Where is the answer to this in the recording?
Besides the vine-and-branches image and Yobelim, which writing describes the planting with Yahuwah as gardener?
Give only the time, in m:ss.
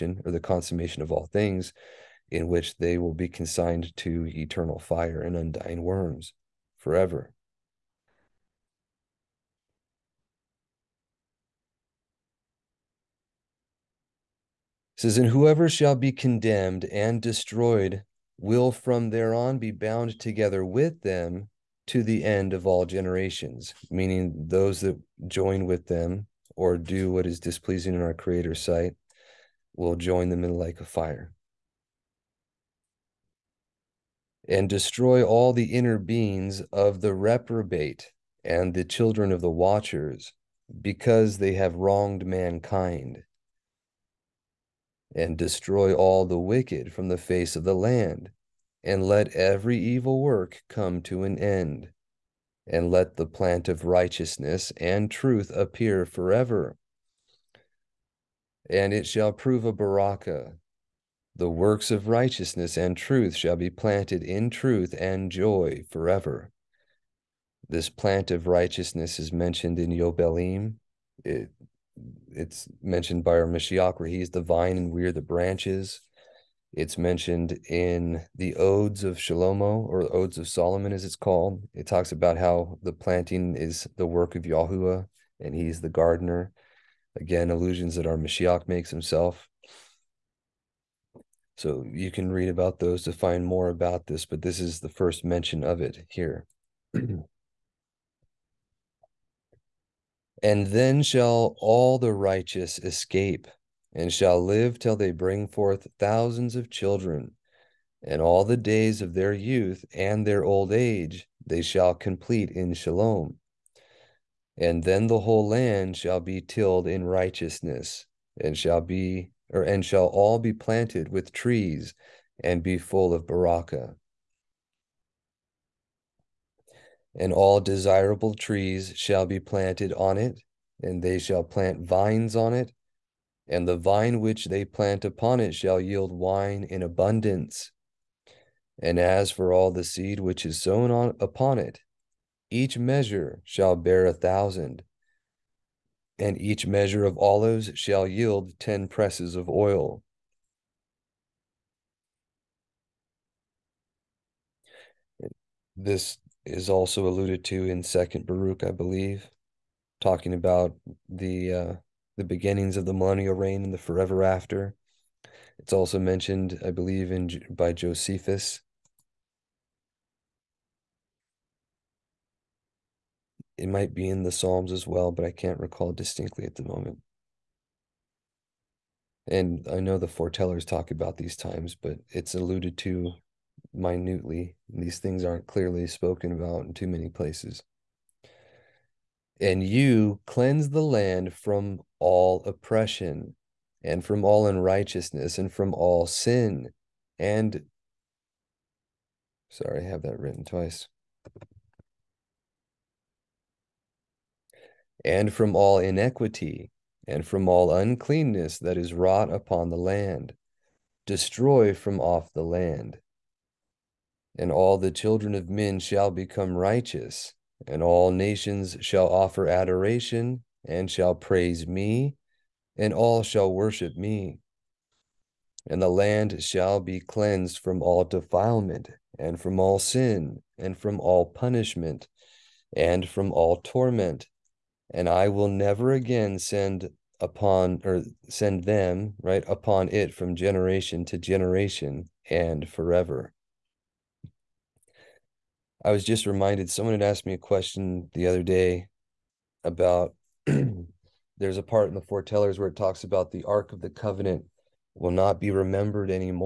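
1:20.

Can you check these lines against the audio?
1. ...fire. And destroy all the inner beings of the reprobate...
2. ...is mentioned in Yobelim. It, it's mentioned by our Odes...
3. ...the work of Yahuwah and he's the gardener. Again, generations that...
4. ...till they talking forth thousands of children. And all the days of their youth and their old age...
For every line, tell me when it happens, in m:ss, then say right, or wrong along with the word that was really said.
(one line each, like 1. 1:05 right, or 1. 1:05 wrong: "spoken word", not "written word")
1. 0:30 right
2. 1:09 wrong: "Mashiach", not "Odes"
3. 1:23 wrong: "allusions", not "generations"
4. 1:44 wrong: "bring", not "talking".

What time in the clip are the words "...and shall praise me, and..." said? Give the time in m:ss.
3:40.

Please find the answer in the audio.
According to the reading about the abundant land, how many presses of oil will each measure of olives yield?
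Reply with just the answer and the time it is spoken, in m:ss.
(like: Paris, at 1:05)
10, at 2:28.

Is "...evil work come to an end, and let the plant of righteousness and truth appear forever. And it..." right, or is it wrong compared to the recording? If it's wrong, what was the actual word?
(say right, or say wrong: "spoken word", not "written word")
right.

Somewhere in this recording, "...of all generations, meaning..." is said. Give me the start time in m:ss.
0:22.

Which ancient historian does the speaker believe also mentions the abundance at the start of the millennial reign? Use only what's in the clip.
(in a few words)
Josephus.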